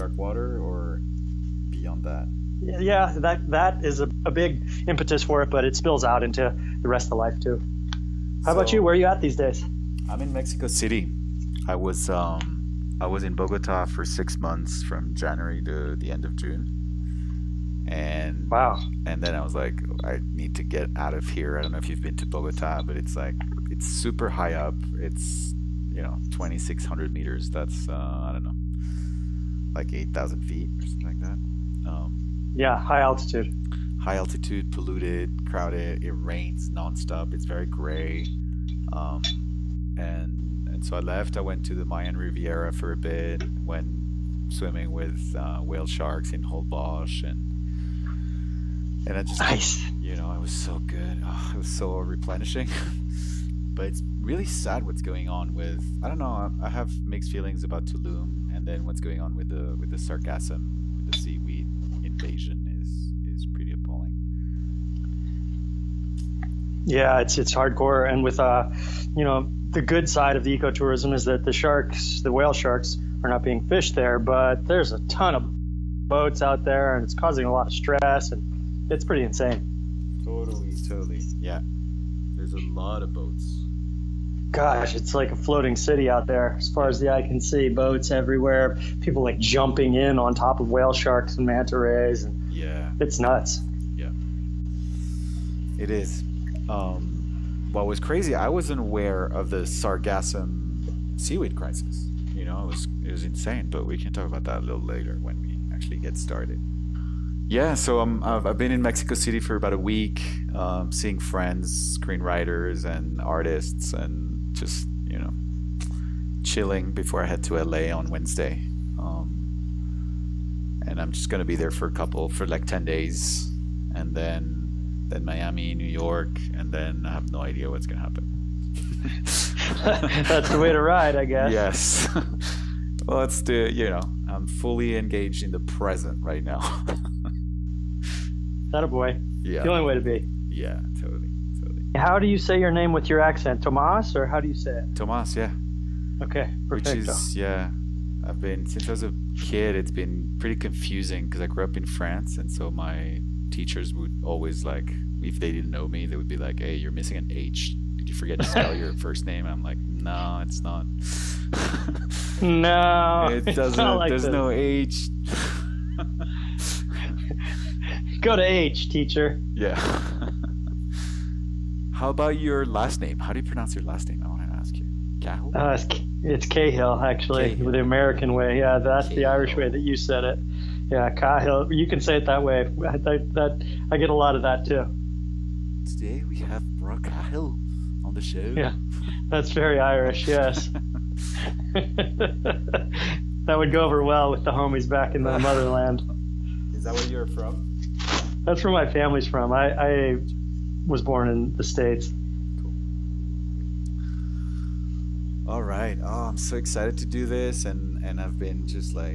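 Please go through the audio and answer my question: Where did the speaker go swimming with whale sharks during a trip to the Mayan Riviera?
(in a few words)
Holbox.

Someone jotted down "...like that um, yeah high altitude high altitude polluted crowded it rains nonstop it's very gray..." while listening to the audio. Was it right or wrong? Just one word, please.
right.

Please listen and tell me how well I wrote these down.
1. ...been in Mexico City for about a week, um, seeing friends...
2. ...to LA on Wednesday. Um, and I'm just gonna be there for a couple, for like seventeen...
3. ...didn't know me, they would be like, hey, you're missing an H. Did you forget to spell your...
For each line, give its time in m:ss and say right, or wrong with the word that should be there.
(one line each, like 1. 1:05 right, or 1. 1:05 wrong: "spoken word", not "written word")
1. 1:48 right
2. 1:57 wrong: "ten", not "seventeen"
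3. 2:35 right.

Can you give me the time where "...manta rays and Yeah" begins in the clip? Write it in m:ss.
1:31.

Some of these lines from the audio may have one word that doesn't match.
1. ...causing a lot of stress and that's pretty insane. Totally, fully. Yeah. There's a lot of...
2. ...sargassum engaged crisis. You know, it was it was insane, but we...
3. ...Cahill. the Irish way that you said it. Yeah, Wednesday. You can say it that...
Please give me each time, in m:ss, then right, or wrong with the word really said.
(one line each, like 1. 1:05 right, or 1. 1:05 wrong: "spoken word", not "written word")
1. 1:17 wrong: "totally", not "fully"
2. 1:39 wrong: "seaweed", not "engaged"
3. 2:59 wrong: "Cahill", not "Wednesday".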